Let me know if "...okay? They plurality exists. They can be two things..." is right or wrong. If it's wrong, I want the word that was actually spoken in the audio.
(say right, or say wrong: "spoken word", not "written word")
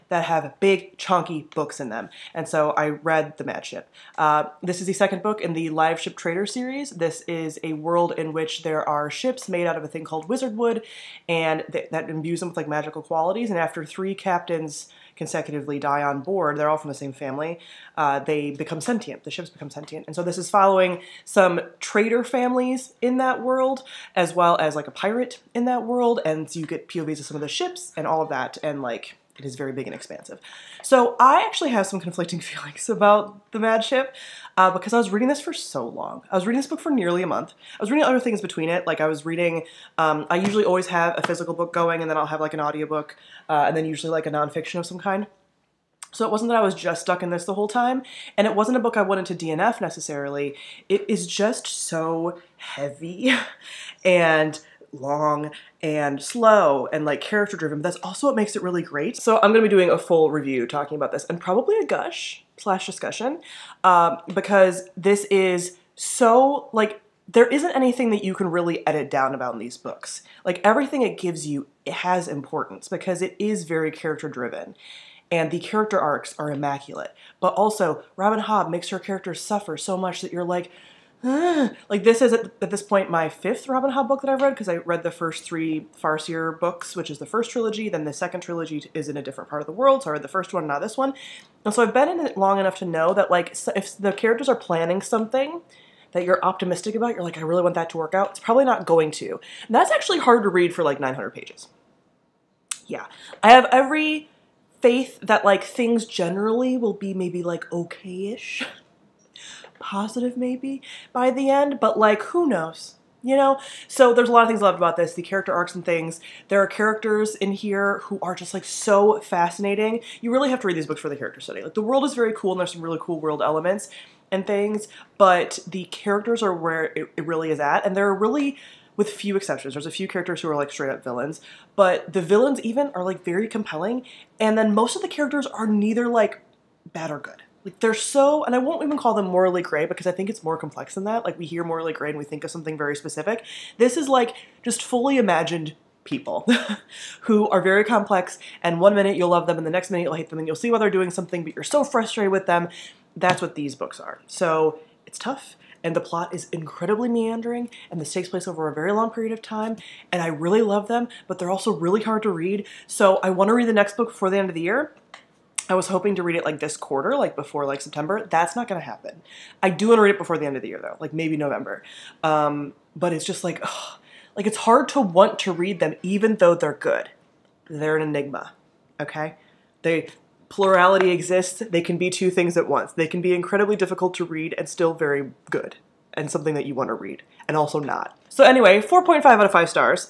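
right.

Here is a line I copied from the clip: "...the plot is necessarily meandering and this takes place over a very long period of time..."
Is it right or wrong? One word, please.
wrong.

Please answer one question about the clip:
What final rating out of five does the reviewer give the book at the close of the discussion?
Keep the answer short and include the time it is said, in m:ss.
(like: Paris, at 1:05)
4.5, at 3:08.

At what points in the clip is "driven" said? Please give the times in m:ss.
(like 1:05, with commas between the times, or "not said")
0:57, 1:14.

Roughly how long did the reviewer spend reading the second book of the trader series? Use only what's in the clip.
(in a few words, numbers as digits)
nearly a month.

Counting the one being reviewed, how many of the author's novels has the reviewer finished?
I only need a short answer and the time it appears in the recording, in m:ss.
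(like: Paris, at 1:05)
5, at 1:23.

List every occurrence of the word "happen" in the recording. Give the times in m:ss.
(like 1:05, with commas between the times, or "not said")
2:48.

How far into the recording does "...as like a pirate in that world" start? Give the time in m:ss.
0:24.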